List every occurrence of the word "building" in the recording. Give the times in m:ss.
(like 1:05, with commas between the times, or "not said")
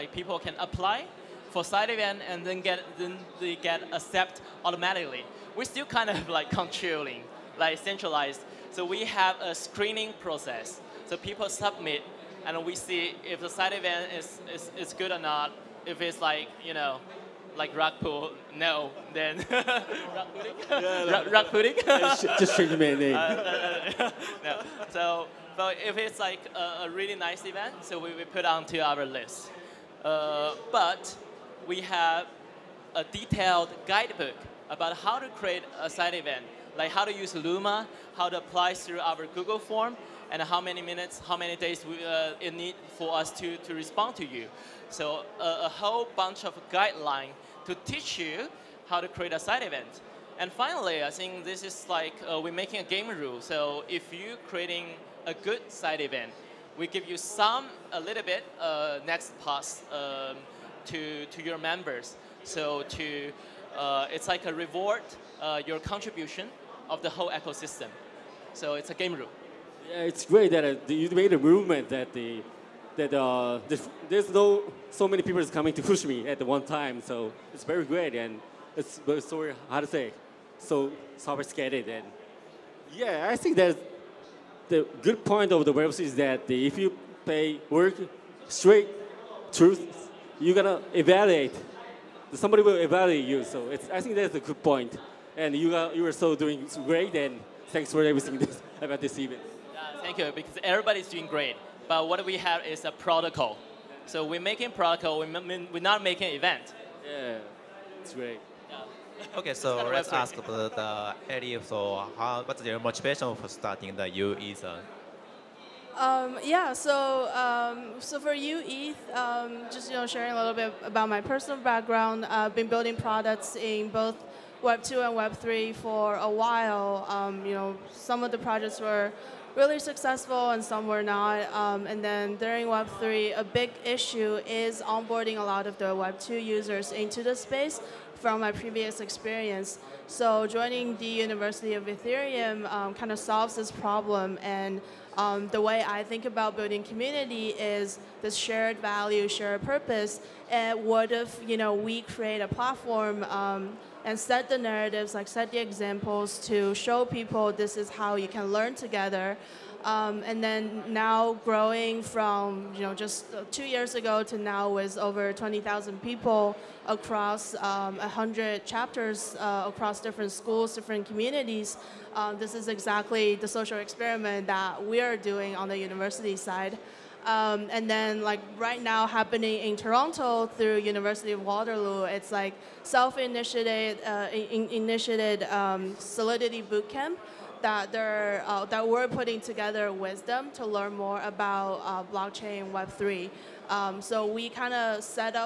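2:02, 2:26.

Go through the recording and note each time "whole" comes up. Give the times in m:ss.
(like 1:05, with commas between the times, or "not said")
0:45, 1:07.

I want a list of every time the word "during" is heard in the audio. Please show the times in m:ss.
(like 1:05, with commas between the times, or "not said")
2:12.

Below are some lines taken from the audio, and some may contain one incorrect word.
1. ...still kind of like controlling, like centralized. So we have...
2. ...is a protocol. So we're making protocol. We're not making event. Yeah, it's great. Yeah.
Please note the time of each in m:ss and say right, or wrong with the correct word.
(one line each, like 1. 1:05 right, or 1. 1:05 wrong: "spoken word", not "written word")
1. 0:05 right
2. 1:42 right.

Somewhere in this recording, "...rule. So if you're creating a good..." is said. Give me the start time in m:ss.
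0:53.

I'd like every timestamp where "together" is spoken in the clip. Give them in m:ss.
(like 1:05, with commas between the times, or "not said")
2:38, 3:09.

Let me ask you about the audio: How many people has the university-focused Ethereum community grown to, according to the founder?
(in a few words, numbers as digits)
20,000.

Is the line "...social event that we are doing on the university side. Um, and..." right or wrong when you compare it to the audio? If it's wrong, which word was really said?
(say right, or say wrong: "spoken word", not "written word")
wrong: "experiment", not "event".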